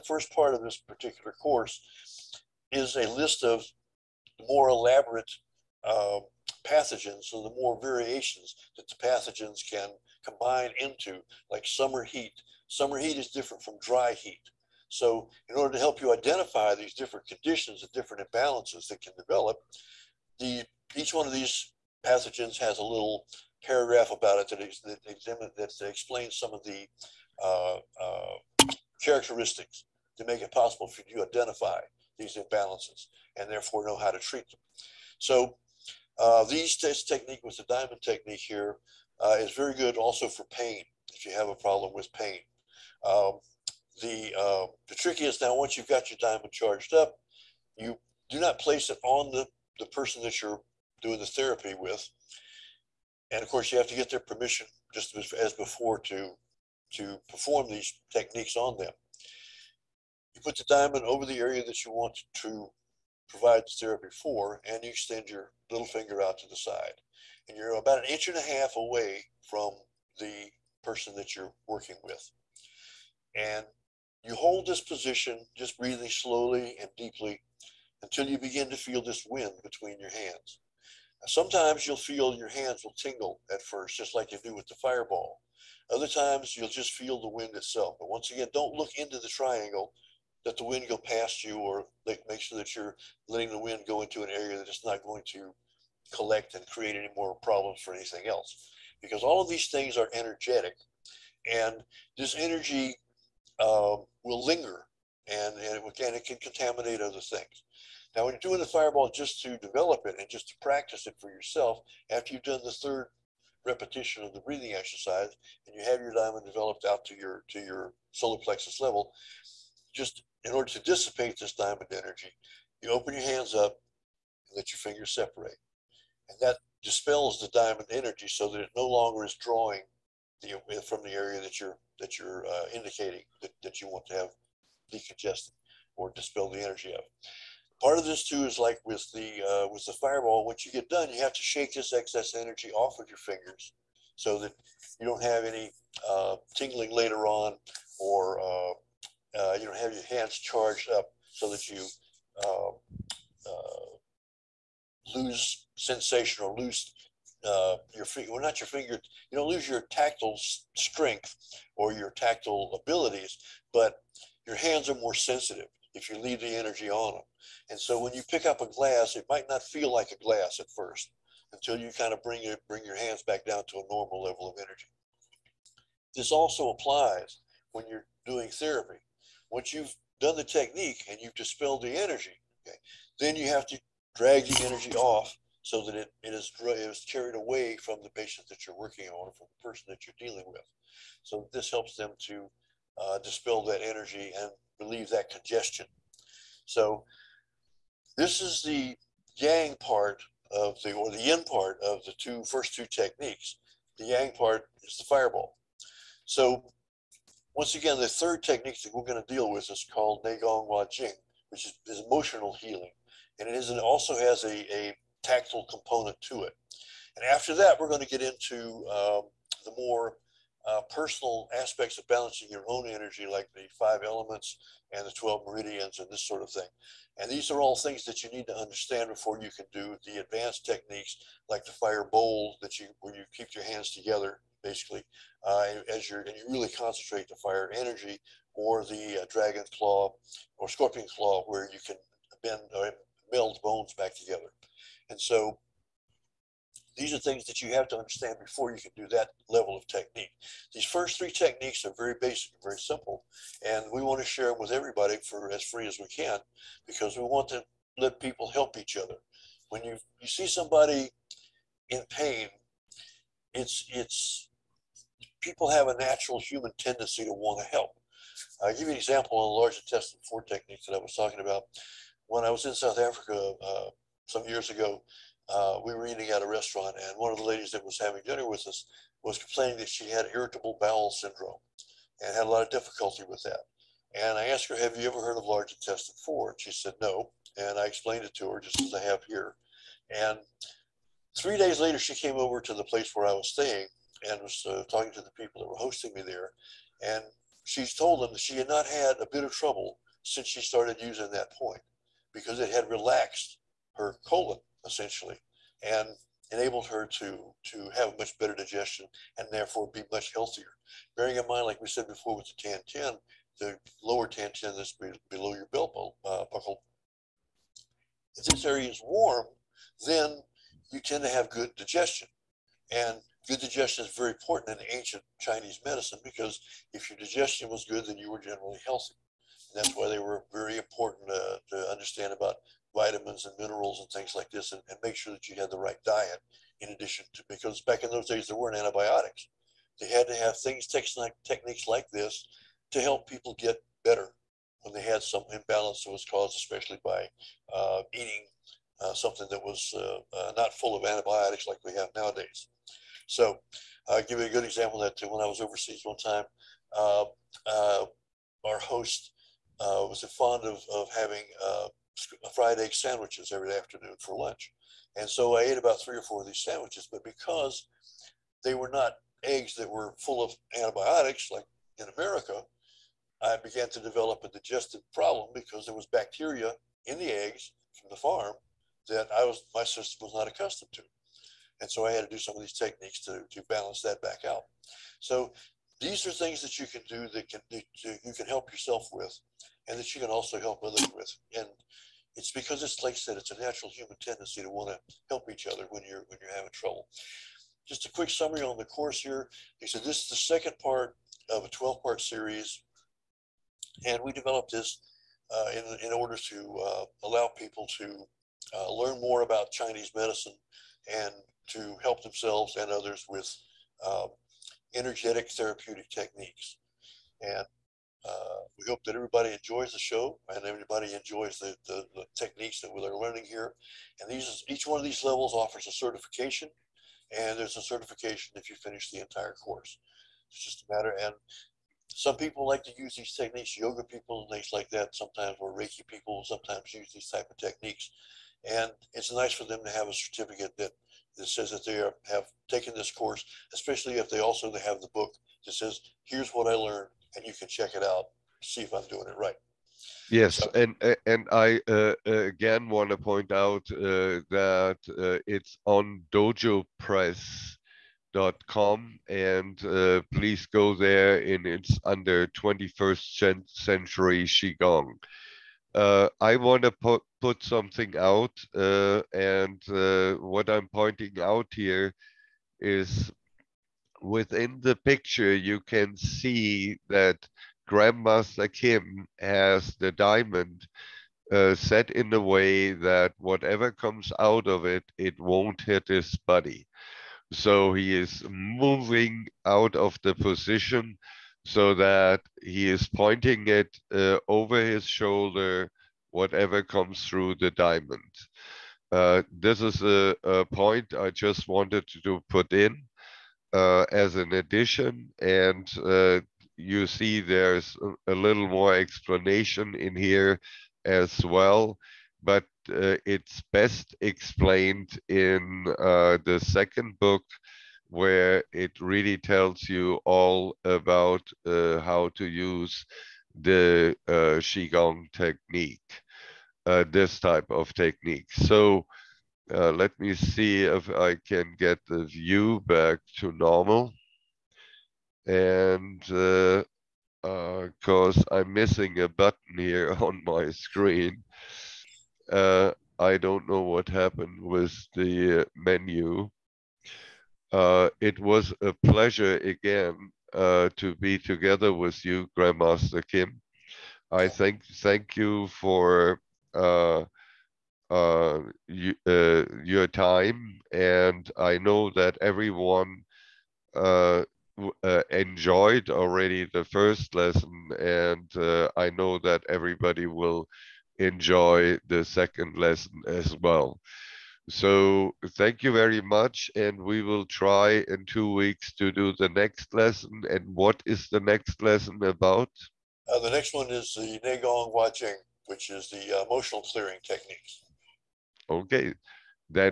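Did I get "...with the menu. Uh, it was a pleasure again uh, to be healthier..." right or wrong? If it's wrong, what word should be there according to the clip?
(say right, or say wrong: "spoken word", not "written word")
wrong: "together", not "healthier".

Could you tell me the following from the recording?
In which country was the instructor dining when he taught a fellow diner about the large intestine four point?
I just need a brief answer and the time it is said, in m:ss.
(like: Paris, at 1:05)
South Africa, at 4:32.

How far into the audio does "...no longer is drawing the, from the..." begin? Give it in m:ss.
2:08.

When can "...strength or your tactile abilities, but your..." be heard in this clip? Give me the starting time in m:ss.
2:40.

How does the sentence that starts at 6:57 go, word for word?
And uh, we hope that everybody enjoys the show and everybody enjoys the, the, the techniques that we're learning here.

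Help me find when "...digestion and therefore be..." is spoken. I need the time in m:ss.
5:08.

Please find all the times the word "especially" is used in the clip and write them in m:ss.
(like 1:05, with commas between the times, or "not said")
5:46, 7:23.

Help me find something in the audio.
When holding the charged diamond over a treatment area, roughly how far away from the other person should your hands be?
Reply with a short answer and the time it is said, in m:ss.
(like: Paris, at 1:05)
An inch and a half, at 1:07.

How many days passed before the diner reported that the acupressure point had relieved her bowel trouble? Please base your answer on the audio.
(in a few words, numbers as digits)
3.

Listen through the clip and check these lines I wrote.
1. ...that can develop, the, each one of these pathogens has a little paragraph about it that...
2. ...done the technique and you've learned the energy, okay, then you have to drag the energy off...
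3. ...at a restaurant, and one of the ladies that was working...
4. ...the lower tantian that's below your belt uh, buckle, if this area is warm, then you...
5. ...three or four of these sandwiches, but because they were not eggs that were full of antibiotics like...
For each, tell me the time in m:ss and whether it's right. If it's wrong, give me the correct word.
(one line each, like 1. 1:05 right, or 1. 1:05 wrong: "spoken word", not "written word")
1. 0:18 right
2. 3:00 wrong: "dispelled", not "learned"
3. 4:36 wrong: "having", not "working"
4. 5:13 right
5. 6:06 right.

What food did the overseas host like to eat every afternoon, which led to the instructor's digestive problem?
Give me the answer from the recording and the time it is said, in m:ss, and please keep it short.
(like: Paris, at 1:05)
Fried egg sandwiches, at 6:02.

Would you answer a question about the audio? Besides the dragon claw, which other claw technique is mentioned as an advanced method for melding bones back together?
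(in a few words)
Scorpion claw.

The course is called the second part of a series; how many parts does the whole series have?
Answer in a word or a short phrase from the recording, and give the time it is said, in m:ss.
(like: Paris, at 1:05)
12, at 6:41.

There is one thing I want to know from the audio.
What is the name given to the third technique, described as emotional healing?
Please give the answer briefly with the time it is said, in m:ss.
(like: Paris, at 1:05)
Neigong Wa Jing, at 3:30.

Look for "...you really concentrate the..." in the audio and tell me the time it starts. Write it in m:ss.
3:56.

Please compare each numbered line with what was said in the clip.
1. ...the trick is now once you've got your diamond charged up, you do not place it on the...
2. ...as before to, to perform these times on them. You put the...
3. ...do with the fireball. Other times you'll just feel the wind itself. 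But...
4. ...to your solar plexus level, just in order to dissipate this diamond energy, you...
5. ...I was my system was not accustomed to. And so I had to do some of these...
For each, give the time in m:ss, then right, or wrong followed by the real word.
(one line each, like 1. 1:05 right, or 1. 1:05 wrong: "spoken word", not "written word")
1. 0:44 right
2. 0:55 wrong: "techniques", not "times"
3. 1:24 right
4. 1:57 right
5. 6:19 right.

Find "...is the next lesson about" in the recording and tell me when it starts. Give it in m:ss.
9:41.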